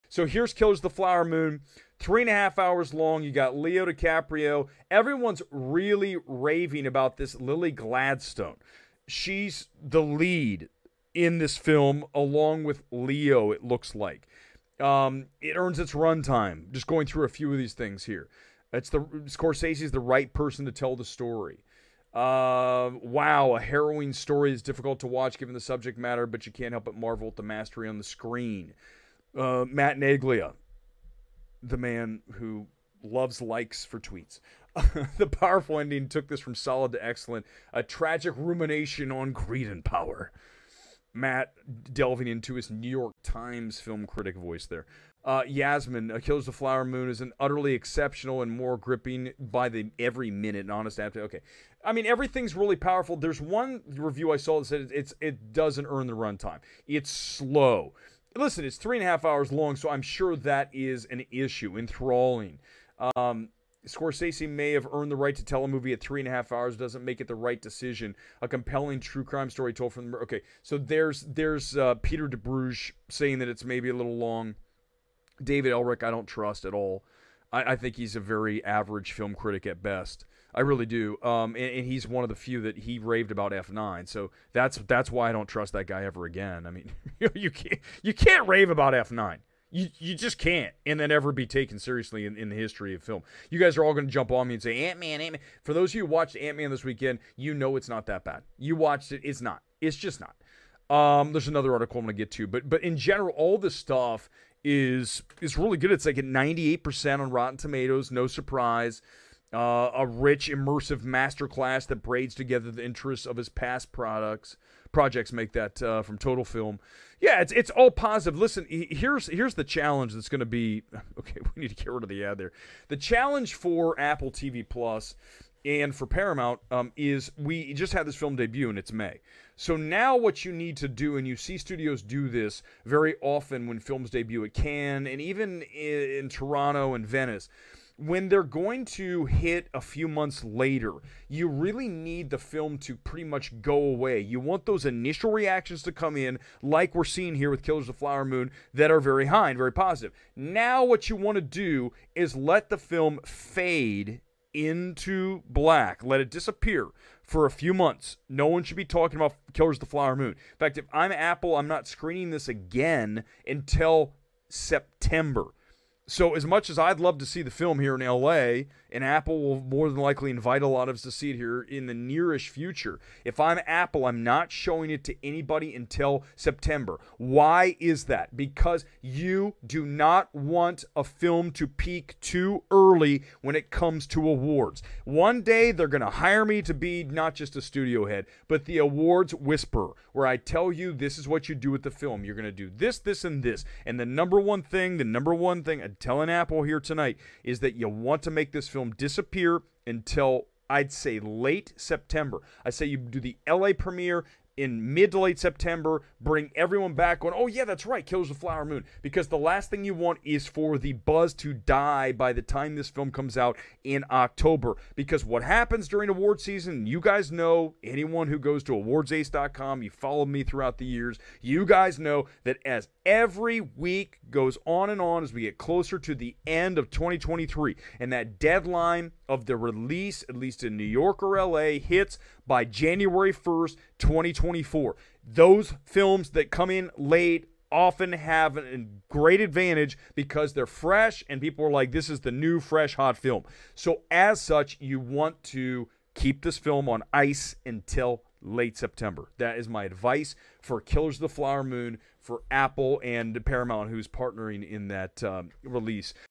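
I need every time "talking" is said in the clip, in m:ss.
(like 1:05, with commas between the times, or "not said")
2:38.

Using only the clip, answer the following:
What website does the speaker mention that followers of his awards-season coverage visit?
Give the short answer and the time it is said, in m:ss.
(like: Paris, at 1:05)
awardsace.com, at 3:38.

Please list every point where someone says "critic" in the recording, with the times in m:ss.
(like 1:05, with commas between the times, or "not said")
0:44, 1:19.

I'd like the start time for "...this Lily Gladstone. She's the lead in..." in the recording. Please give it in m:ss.
0:07.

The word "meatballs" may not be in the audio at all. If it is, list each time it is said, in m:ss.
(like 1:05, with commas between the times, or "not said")
not said.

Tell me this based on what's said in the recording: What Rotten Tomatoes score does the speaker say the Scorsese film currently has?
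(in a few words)
98%.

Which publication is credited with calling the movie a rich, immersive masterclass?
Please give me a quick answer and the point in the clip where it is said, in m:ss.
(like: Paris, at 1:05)
Total Film, at 1:56.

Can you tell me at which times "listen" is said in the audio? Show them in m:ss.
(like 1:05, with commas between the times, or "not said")
0:58, 1:58.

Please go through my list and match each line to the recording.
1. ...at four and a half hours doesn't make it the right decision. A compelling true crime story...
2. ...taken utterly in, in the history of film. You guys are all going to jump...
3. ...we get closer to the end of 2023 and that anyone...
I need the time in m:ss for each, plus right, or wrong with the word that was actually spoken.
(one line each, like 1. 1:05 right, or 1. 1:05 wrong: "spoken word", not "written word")
1. 1:05 wrong: "three", not "four"
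2. 1:31 wrong: "seriously", not "utterly"
3. 3:45 wrong: "deadline", not "anyone".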